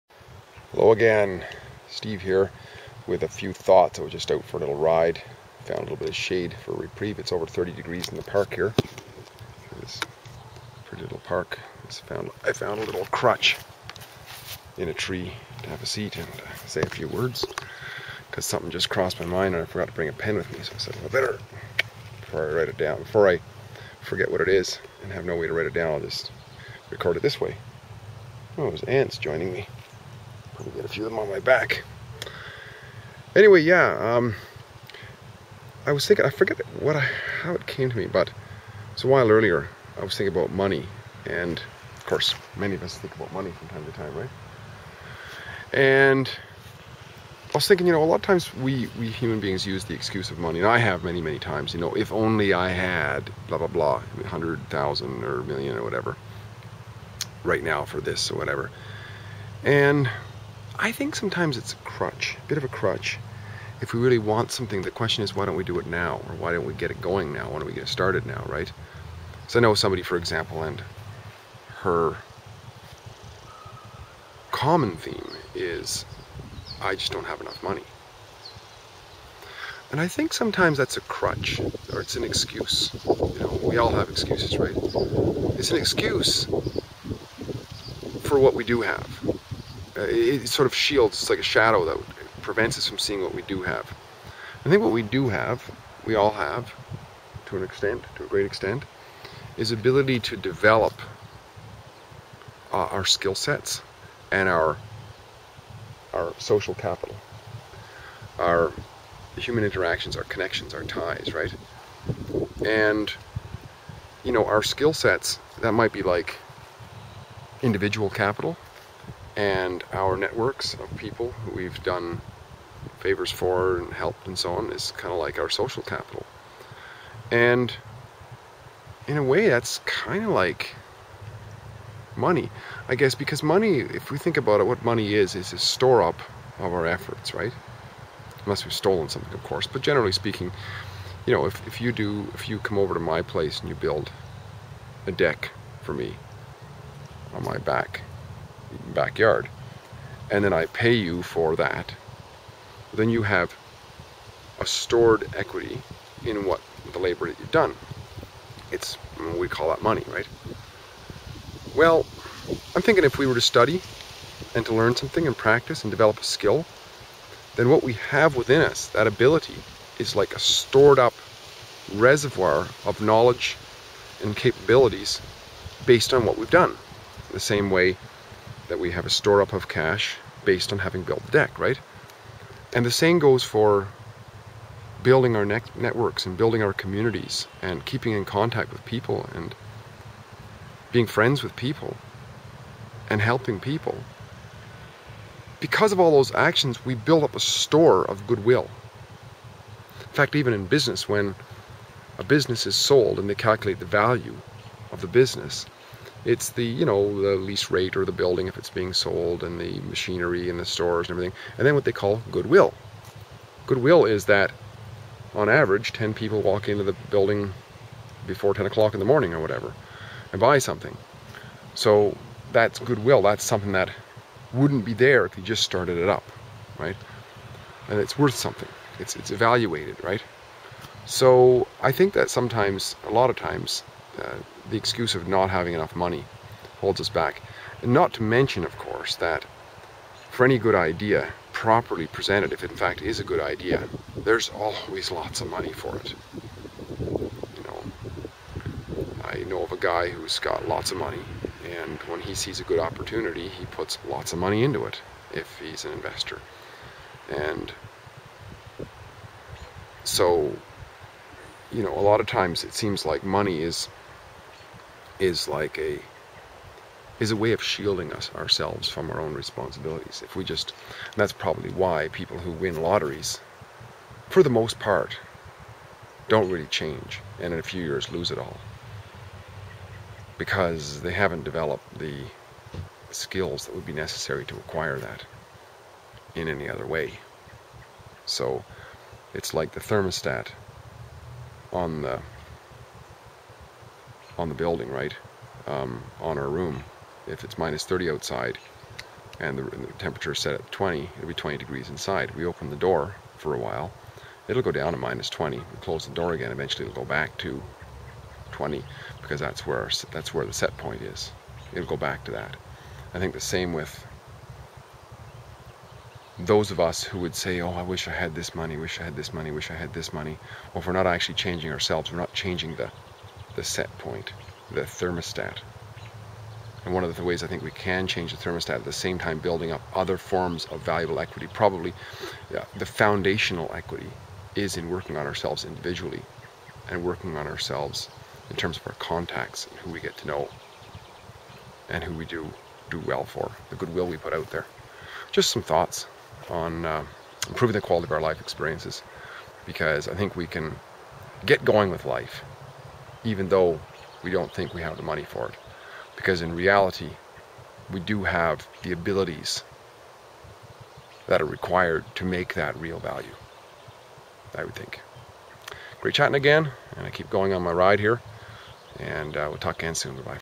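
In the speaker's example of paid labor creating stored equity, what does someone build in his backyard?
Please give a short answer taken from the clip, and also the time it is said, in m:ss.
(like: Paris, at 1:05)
a deck, at 2:25.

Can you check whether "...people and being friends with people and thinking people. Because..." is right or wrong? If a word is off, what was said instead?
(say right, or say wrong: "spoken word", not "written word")
wrong: "helping", not "thinking".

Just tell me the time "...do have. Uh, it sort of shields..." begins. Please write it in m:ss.
1:28.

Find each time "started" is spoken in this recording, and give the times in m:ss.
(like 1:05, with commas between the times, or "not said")
1:07, 3:45.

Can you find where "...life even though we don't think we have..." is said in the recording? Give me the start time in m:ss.
5:52.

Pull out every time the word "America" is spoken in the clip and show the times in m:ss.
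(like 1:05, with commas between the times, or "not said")
not said.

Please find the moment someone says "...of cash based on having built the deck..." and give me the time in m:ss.
2:59.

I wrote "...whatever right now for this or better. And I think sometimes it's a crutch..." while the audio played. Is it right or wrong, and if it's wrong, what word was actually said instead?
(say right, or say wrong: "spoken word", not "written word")
wrong: "whatever", not "better".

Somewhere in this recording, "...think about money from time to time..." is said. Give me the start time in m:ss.
0:42.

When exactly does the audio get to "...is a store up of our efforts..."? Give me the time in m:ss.
2:15.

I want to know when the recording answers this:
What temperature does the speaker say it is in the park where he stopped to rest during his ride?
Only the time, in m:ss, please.
0:07.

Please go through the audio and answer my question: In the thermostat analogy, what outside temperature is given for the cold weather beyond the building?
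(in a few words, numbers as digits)
minus 30.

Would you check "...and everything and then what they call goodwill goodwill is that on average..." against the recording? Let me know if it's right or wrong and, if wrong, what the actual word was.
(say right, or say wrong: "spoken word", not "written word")
right.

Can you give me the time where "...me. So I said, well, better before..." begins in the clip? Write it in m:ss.
0:20.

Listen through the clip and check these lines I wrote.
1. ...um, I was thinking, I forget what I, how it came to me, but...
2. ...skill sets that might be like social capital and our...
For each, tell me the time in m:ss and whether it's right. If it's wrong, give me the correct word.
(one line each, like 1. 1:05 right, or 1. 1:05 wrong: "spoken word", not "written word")
1. 0:34 right
2. 1:54 wrong: "individual", not "social".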